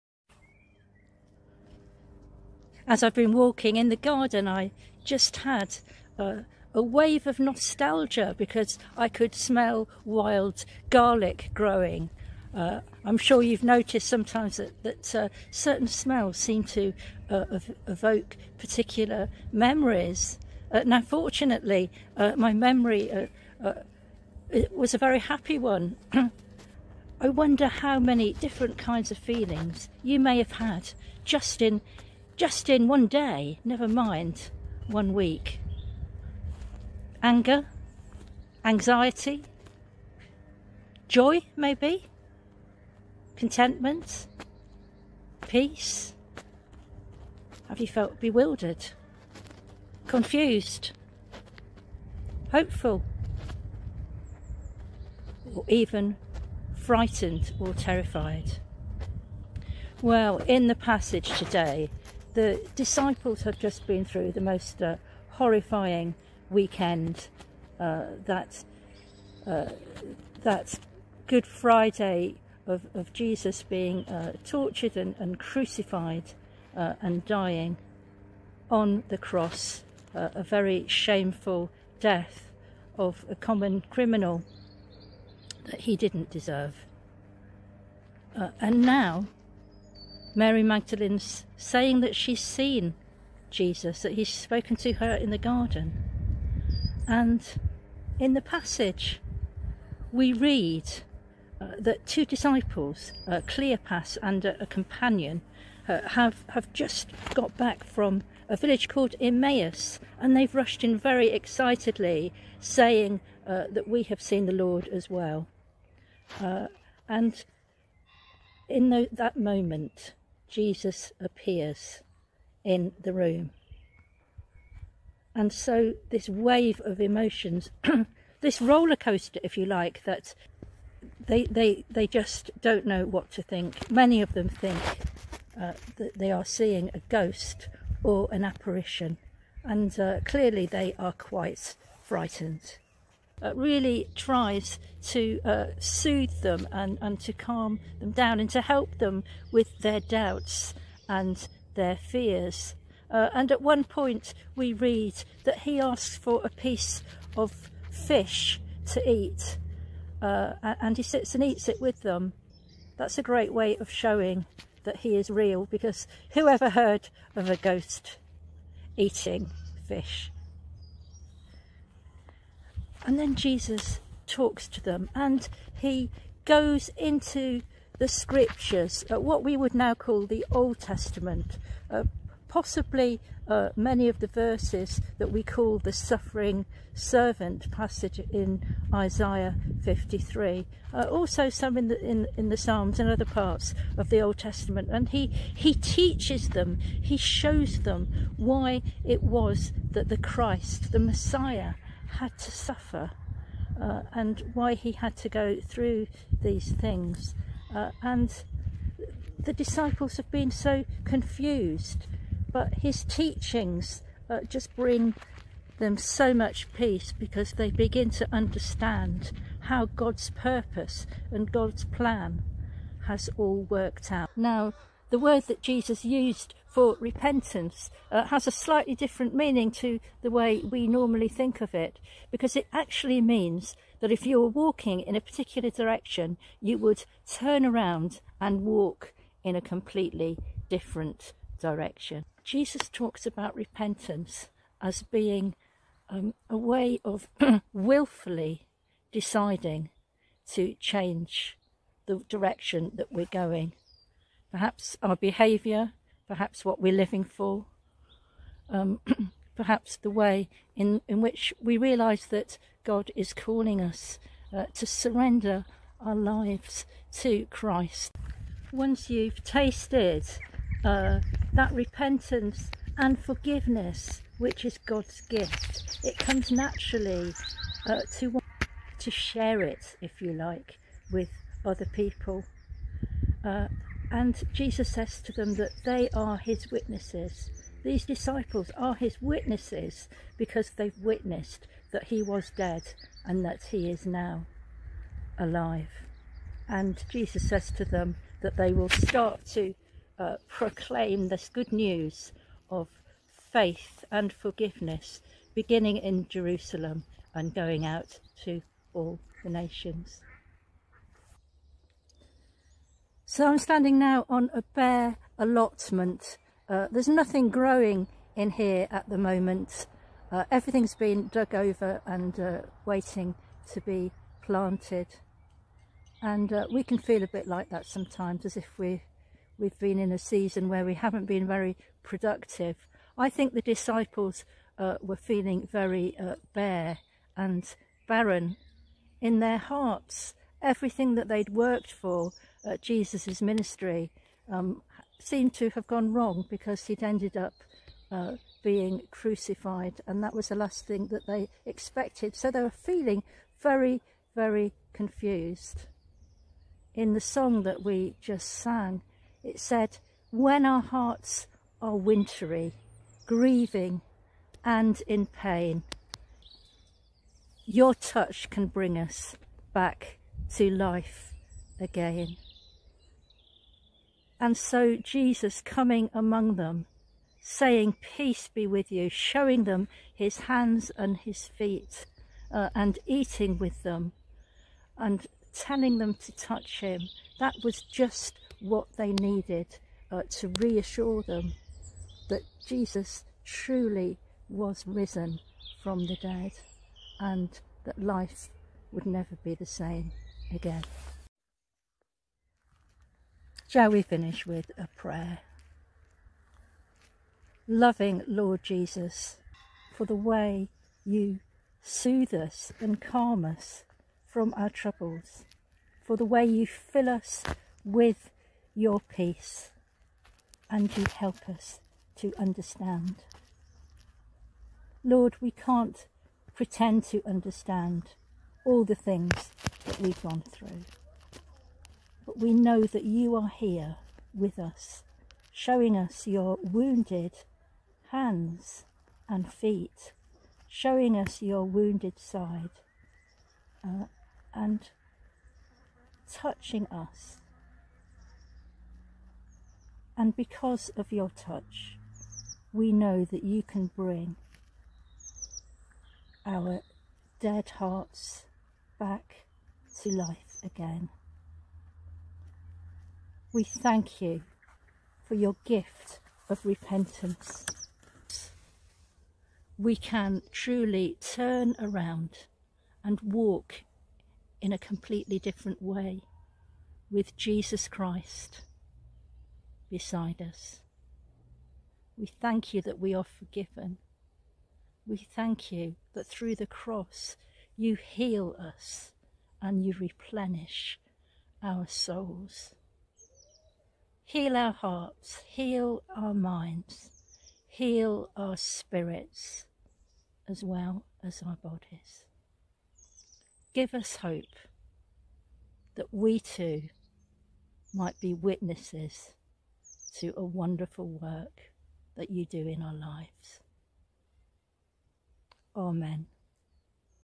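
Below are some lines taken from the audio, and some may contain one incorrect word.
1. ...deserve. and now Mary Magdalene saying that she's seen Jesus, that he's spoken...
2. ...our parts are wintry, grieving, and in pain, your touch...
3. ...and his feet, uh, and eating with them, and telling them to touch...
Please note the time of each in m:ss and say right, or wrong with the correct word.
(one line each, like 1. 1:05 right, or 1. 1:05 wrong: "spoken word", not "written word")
1. 1:26 right
2. 6:00 wrong: "hearts", not "parts"
3. 6:20 right.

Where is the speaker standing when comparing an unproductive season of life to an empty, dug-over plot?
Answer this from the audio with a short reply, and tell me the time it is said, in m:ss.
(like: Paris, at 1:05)
A bare allotment, at 5:14.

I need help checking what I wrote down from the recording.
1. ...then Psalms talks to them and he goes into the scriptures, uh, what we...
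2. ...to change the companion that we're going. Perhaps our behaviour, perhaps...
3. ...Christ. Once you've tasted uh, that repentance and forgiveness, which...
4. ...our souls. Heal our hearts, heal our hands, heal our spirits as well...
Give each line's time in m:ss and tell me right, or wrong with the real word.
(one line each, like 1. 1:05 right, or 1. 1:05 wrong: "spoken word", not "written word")
1. 2:53 wrong: "Jesus", not "Psalms"
2. 4:10 wrong: "direction", not "companion"
3. 4:27 right
4. 8:11 wrong: "minds", not "hands".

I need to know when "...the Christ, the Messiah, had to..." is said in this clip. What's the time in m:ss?
3:20.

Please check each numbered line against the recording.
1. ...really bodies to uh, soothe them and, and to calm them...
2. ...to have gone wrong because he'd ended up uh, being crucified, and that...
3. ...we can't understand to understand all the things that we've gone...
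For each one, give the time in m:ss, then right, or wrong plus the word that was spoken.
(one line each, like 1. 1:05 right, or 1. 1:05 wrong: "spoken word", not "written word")
1. 2:23 wrong: "tries", not "bodies"
2. 5:45 right
3. 7:05 wrong: "pretend", not "understand".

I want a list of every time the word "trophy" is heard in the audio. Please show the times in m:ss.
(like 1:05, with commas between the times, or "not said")
not said.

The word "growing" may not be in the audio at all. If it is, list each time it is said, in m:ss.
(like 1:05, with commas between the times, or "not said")
0:11, 5:17.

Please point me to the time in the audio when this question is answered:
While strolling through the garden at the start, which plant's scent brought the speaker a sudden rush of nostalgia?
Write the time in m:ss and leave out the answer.
0:10.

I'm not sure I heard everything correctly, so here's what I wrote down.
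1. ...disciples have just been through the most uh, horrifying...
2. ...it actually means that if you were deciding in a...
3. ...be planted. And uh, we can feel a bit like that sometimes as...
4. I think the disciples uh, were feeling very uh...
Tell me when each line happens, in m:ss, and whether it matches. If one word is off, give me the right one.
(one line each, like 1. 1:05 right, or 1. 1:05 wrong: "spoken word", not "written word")
1. 1:02 right
2. 3:52 wrong: "walking", not "deciding"
3. 5:23 right
4. 5:33 right.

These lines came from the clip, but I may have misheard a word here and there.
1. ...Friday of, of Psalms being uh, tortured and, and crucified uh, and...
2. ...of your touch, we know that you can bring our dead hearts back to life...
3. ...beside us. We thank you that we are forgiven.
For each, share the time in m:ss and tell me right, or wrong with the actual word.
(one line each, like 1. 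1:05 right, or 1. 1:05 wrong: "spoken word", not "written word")
1. 1:11 wrong: "Jesus", not "Psalms"
2. 7:30 right
3. 7:59 right.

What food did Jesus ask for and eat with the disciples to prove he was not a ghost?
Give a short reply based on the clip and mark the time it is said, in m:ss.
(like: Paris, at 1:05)
A piece of fish, at 2:36.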